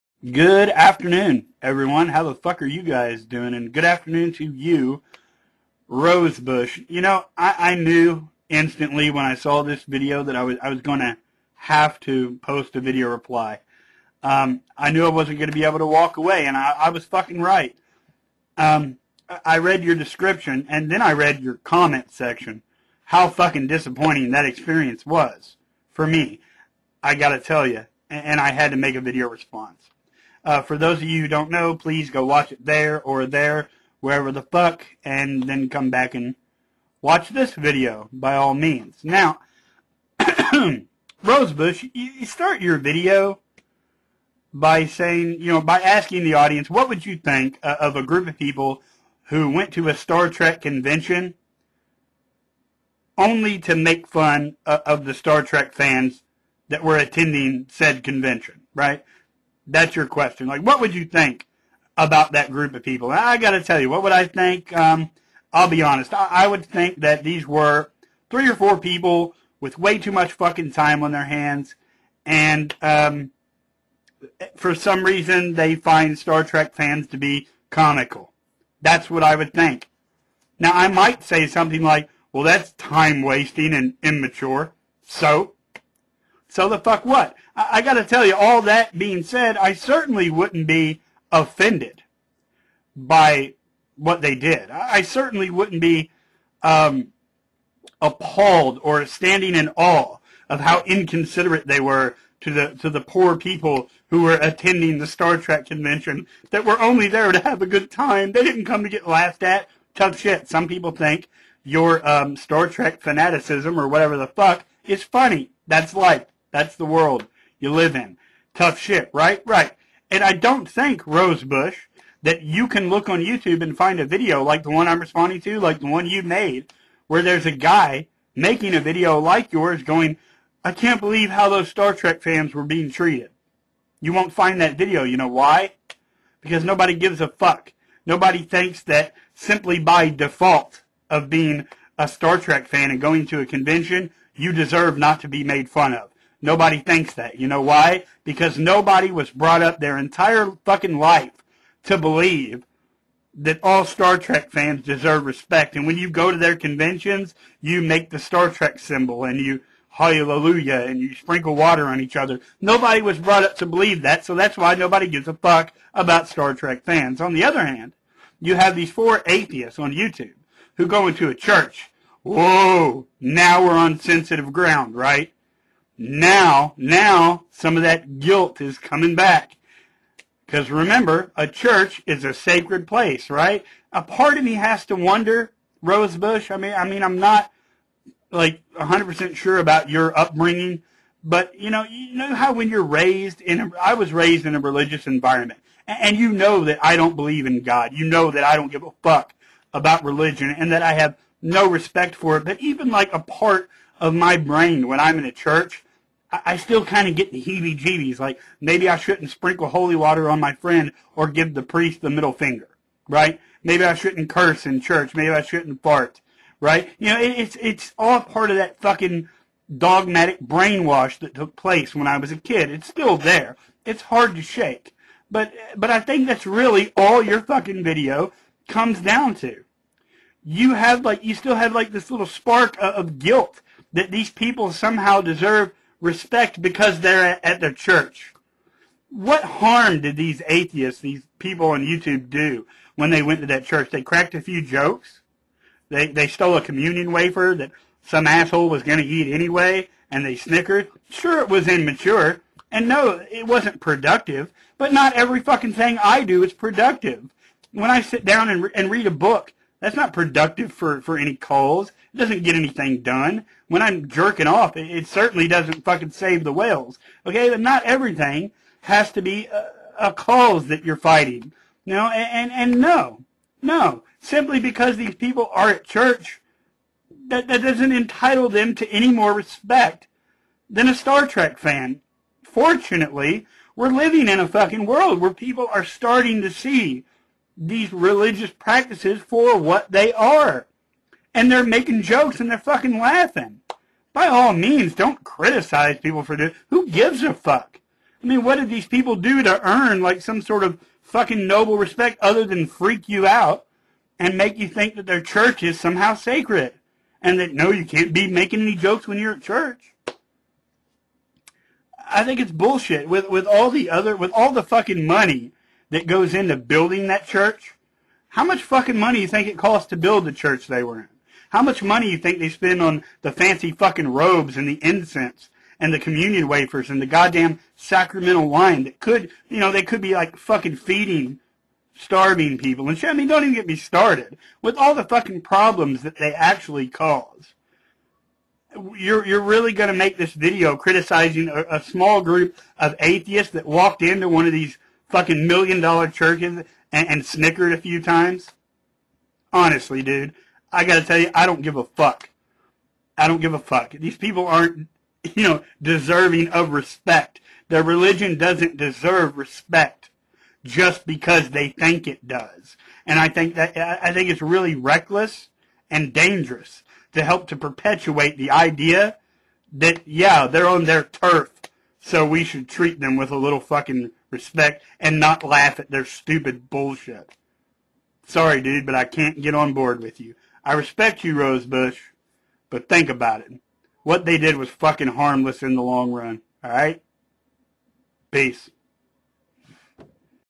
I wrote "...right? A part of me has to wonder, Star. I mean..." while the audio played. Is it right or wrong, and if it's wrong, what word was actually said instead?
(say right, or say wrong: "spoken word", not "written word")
wrong: "Rosebush", not "Star".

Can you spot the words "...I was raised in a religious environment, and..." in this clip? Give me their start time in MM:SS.
03:13.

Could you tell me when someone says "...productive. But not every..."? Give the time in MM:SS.
04:13.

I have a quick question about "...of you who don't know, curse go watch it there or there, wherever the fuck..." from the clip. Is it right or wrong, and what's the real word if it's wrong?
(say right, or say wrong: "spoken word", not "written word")
wrong: "please", not "curse".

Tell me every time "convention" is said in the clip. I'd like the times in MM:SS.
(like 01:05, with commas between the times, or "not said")
00:50, 00:58, 01:45, 02:23, 02:36.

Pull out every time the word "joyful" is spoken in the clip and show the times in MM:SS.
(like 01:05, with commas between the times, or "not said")
not said.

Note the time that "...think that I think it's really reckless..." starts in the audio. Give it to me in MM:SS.
06:03.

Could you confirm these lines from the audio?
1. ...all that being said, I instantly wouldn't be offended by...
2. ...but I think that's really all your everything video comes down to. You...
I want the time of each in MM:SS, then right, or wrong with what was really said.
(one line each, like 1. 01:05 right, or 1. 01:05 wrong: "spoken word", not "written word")
1. 01:28 wrong: "certainly", not "instantly"
2. 03:45 wrong: "fucking", not "everything".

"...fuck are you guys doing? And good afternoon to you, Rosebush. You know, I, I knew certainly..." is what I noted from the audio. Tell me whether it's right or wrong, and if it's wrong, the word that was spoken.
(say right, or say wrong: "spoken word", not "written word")
wrong: "instantly", not "certainly".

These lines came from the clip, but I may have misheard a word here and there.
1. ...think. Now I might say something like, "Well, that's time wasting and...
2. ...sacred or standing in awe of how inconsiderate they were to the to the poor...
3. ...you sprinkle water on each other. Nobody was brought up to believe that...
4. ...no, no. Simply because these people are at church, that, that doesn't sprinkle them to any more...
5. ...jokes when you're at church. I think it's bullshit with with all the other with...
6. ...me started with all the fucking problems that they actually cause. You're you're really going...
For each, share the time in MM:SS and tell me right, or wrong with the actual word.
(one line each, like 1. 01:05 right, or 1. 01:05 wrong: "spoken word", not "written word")
1. 01:19 right
2. 01:38 wrong: "appalled", not "sacred"
3. 02:40 right
4. 04:32 wrong: "entitle", not "sprinkle"
5. 05:08 right
6. 05:33 right.